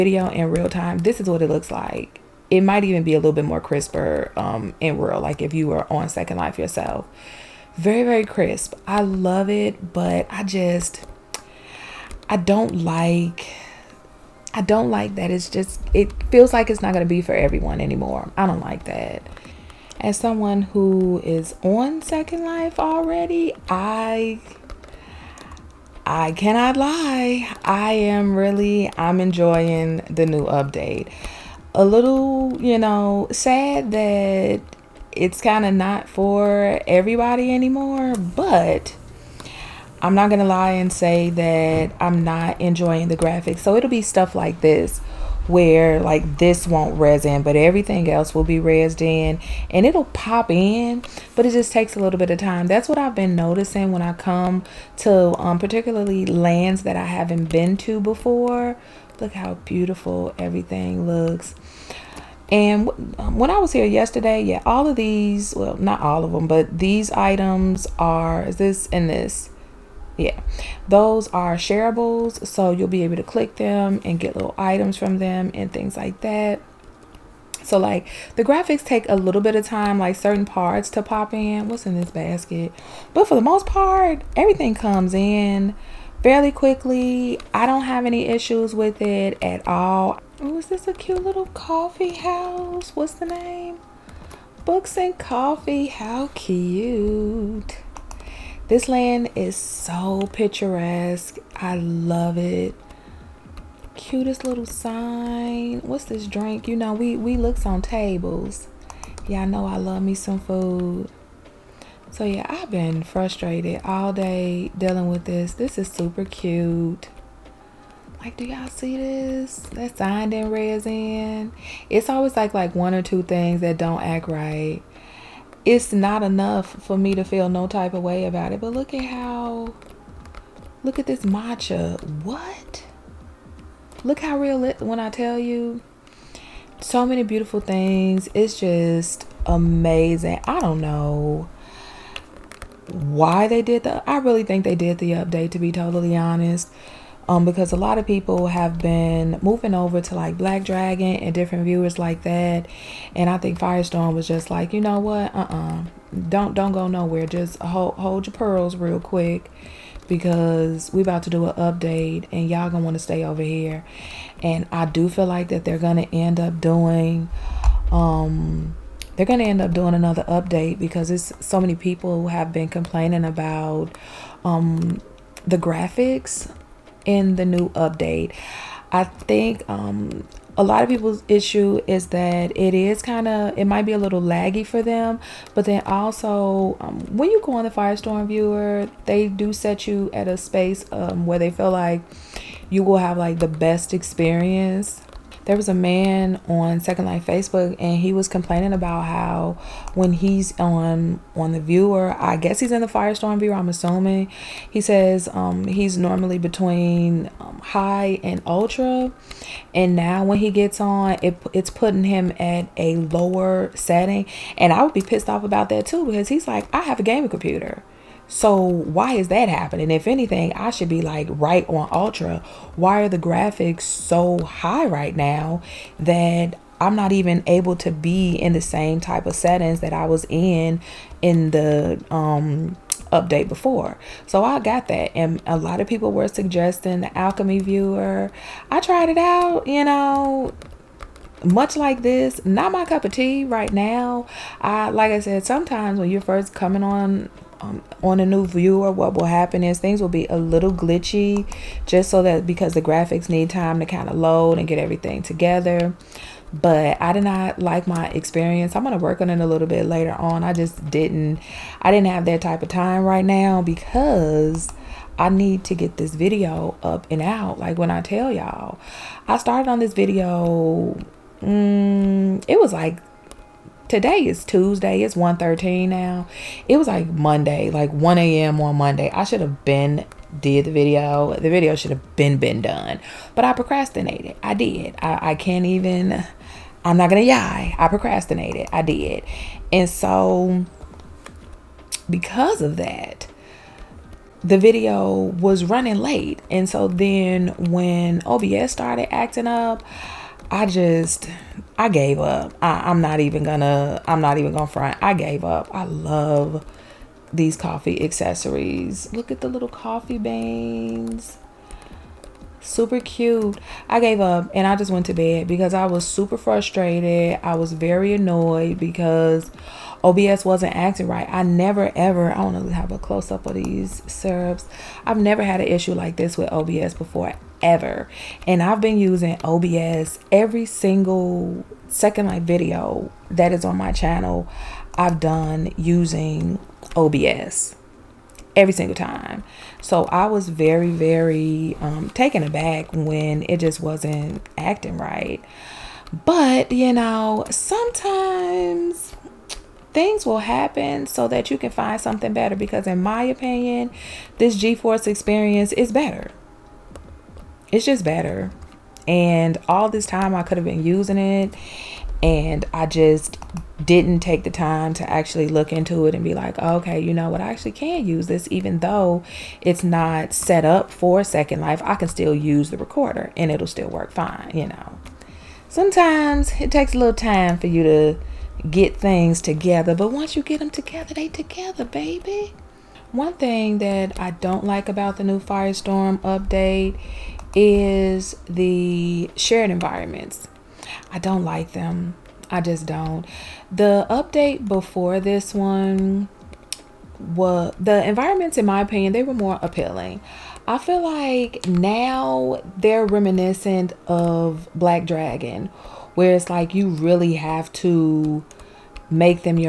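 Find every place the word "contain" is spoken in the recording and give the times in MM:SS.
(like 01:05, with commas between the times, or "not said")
not said.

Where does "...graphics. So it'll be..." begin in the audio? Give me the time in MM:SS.
00:43.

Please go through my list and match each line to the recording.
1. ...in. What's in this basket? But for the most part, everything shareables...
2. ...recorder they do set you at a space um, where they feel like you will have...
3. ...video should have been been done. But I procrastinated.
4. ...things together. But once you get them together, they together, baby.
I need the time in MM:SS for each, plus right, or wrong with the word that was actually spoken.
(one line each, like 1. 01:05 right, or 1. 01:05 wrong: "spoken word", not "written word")
1. 01:21 wrong: "comes", not "shareables"
2. 03:08 wrong: "viewer", not "recorder"
3. 04:41 right
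4. 06:18 right.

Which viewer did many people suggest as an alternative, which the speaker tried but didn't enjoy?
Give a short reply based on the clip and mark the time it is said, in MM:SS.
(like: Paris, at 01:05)
Alchemy Viewer, at 03:57.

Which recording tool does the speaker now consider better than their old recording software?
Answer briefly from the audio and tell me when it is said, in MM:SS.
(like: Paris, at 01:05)
GeForce Experience, at 05:54.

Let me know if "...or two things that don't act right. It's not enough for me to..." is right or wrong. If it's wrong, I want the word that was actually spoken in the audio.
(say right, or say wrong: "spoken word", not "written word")
right.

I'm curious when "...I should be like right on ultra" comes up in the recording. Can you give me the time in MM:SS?
03:40.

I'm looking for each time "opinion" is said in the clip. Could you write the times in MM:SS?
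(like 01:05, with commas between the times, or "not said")
05:53, 06:38.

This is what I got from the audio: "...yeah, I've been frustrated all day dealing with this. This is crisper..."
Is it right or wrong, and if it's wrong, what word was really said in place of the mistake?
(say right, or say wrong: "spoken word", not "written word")
wrong: "super", not "crisper".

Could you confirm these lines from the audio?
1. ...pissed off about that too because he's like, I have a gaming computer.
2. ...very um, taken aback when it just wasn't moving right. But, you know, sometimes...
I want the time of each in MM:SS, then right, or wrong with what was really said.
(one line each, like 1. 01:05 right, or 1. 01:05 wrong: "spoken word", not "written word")
1. 03:35 right
2. 05:40 wrong: "acting", not "moving".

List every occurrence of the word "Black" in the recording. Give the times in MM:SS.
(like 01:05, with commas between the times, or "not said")
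02:30, 06:44.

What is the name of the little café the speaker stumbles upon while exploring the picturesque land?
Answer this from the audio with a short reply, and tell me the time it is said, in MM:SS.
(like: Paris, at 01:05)
Books and Coffee, at 01:34.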